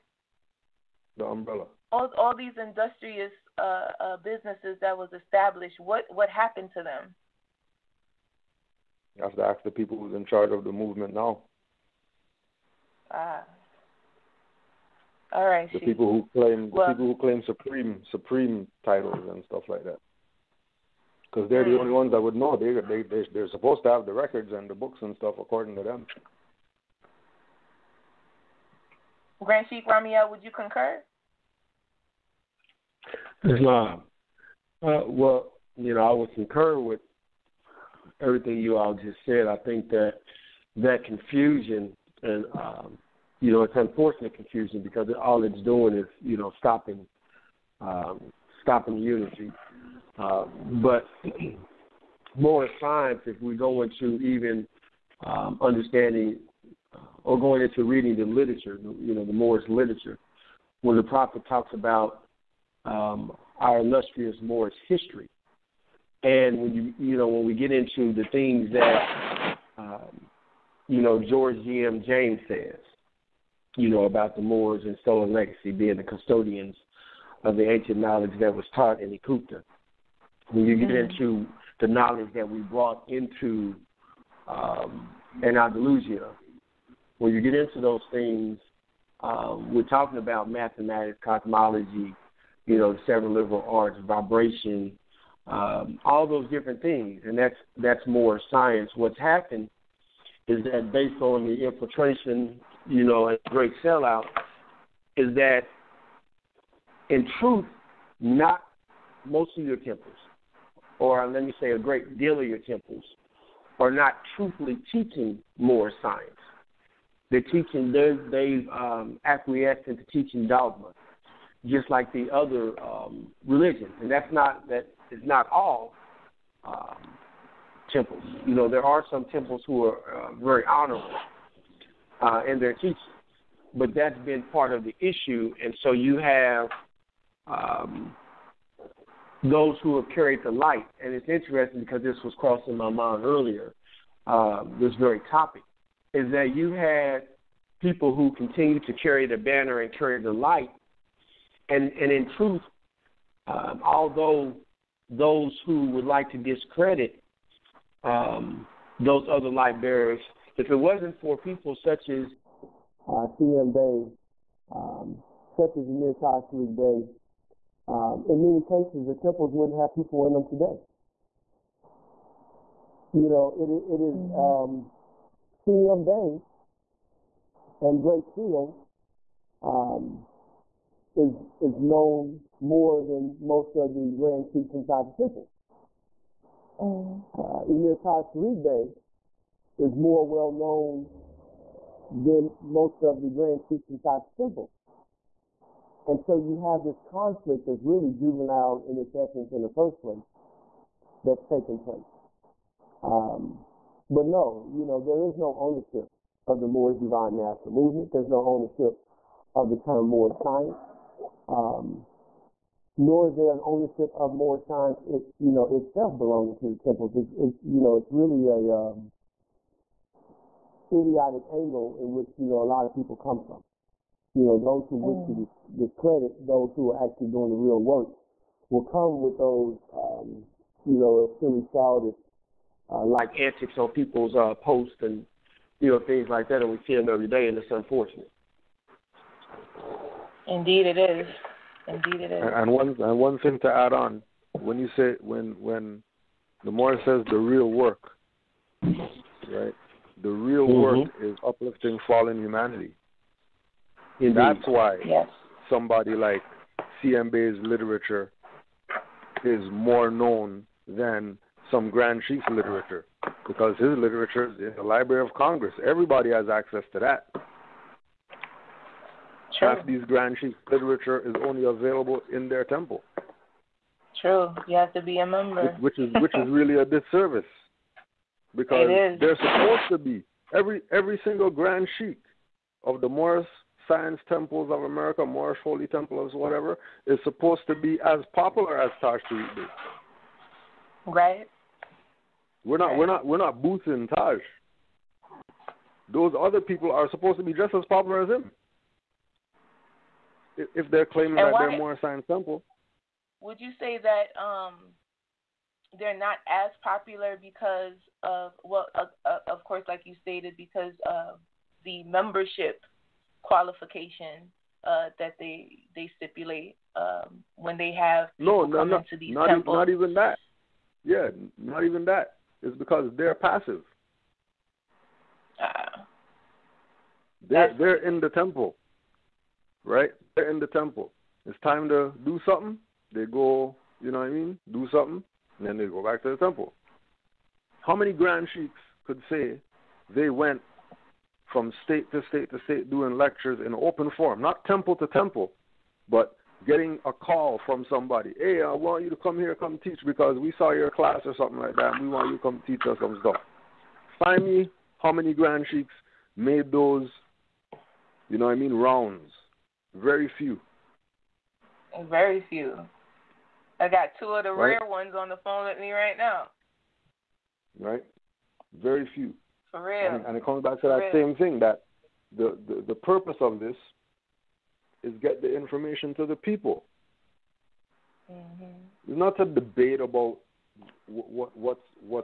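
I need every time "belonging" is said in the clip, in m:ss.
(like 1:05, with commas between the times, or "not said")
3:36.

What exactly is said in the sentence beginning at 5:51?
and we want you to come teach us some stuff.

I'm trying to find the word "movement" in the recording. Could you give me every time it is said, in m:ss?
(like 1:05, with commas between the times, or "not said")
0:10, 3:27.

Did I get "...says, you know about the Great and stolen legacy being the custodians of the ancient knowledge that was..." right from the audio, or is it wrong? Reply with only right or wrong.
wrong.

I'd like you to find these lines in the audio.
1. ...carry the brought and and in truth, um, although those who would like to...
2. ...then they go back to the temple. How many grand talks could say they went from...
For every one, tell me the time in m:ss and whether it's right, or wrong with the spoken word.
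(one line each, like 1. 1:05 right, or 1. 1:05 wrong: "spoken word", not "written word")
1. 2:29 wrong: "light", not "brought"
2. 5:35 wrong: "sheiks", not "talks".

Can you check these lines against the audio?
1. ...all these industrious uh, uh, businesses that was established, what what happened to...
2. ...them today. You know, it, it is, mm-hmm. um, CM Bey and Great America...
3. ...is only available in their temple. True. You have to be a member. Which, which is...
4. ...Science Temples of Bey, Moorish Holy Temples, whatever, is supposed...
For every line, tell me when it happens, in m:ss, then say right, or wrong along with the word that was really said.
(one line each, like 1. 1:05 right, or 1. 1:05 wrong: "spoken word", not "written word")
1. 0:02 right
2. 2:50 wrong: "Seal", not "America"
3. 4:31 right
4. 4:43 wrong: "America", not "Bey".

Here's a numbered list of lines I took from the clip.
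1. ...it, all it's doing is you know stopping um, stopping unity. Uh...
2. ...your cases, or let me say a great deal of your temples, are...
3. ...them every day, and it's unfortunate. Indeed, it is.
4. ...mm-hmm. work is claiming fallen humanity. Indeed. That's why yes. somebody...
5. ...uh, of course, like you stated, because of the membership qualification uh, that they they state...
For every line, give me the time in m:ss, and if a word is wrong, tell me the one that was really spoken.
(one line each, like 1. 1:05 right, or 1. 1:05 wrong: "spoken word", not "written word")
1. 0:45 right
2. 1:49 wrong: "temples", not "cases"
3. 3:56 right
4. 4:10 wrong: "uplifting", not "claiming"
5. 5:09 wrong: "stipulate", not "state".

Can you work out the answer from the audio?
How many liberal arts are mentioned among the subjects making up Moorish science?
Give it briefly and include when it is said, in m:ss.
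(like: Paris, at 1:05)
7, at 1:33.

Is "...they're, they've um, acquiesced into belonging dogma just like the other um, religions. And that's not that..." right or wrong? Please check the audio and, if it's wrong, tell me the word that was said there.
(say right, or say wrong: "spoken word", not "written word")
wrong: "teaching", not "belonging".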